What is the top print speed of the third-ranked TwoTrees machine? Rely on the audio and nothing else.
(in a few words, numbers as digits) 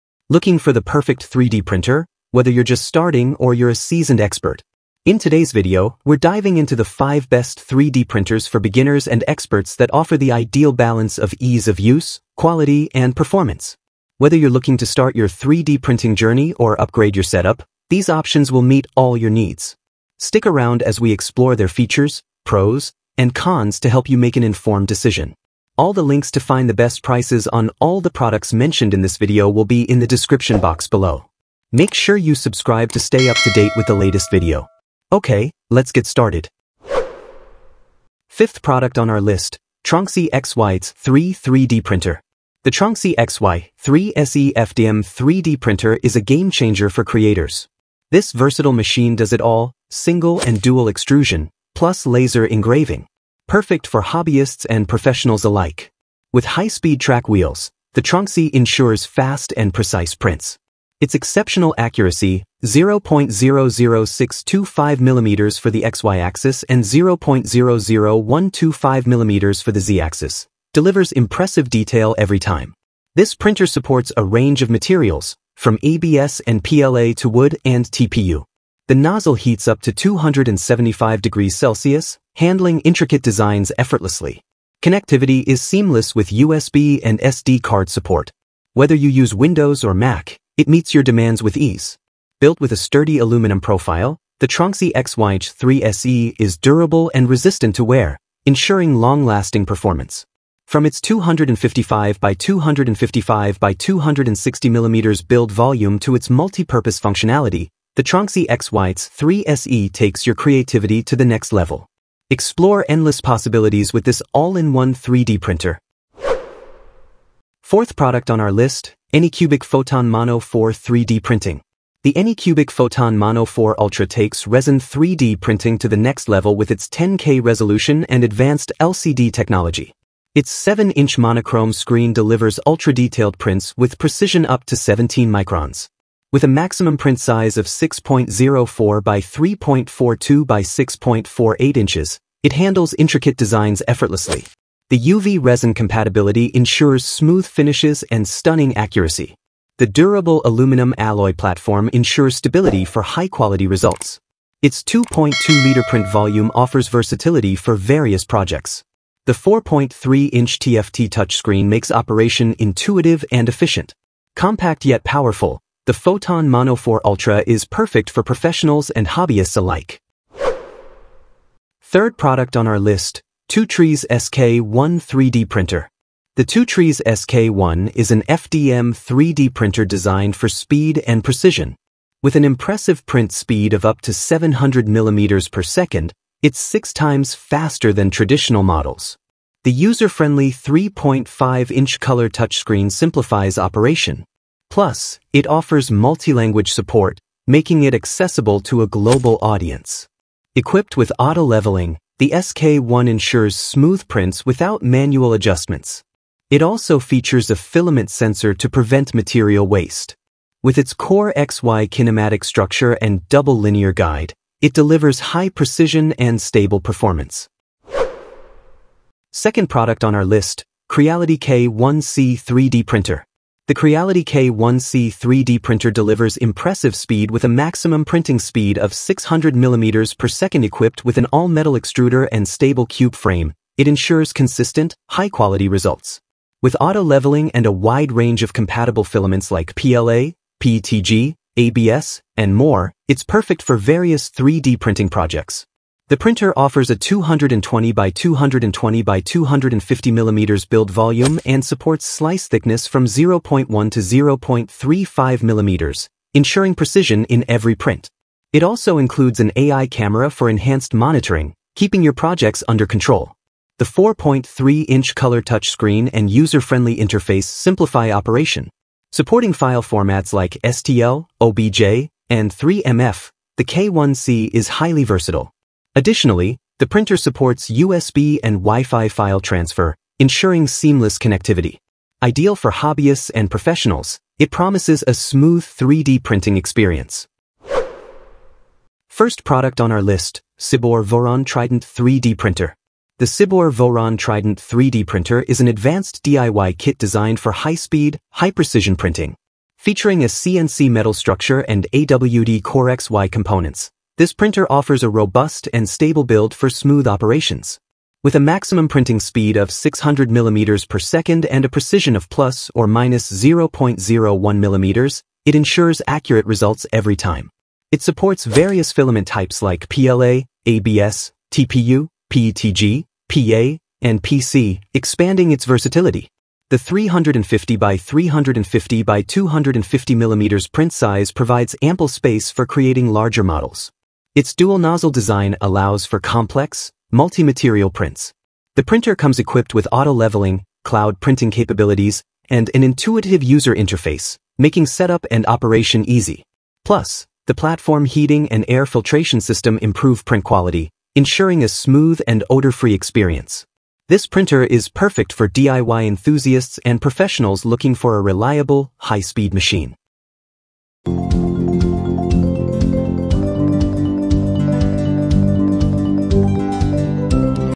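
700 mm per second.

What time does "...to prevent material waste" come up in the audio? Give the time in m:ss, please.
3:28.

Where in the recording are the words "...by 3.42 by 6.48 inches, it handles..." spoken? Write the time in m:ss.
2:19.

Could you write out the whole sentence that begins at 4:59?
Featuring a CNC metal structure and AWD CoreXY components, this printer offers a robust and stable build for smooth operations.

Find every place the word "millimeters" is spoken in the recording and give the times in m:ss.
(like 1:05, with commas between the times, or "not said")
3:04, 5:10, 5:14, 5:30.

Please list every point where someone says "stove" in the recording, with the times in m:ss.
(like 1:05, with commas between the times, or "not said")
not said.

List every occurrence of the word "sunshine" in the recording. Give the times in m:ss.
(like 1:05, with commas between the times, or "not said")
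not said.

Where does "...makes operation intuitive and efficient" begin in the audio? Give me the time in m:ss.
2:41.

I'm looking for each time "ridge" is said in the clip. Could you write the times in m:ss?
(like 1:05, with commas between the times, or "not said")
not said.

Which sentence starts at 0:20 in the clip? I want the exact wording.
Stick around as we explore their features, pros, and cons to help you make an informed decision.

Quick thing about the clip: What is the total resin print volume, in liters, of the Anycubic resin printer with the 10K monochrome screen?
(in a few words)
2.2 liters.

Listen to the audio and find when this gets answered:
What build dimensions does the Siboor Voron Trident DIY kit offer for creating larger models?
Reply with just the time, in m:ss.
5:26.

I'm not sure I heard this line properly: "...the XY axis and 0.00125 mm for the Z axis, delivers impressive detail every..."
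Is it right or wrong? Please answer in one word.
right.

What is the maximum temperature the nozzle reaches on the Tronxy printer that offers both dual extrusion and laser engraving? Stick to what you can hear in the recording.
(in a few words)
275 degrees Celsius.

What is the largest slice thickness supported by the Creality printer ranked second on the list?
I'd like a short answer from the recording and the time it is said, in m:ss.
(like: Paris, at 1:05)
0.35 mm, at 4:14.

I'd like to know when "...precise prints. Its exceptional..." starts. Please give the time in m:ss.
0:59.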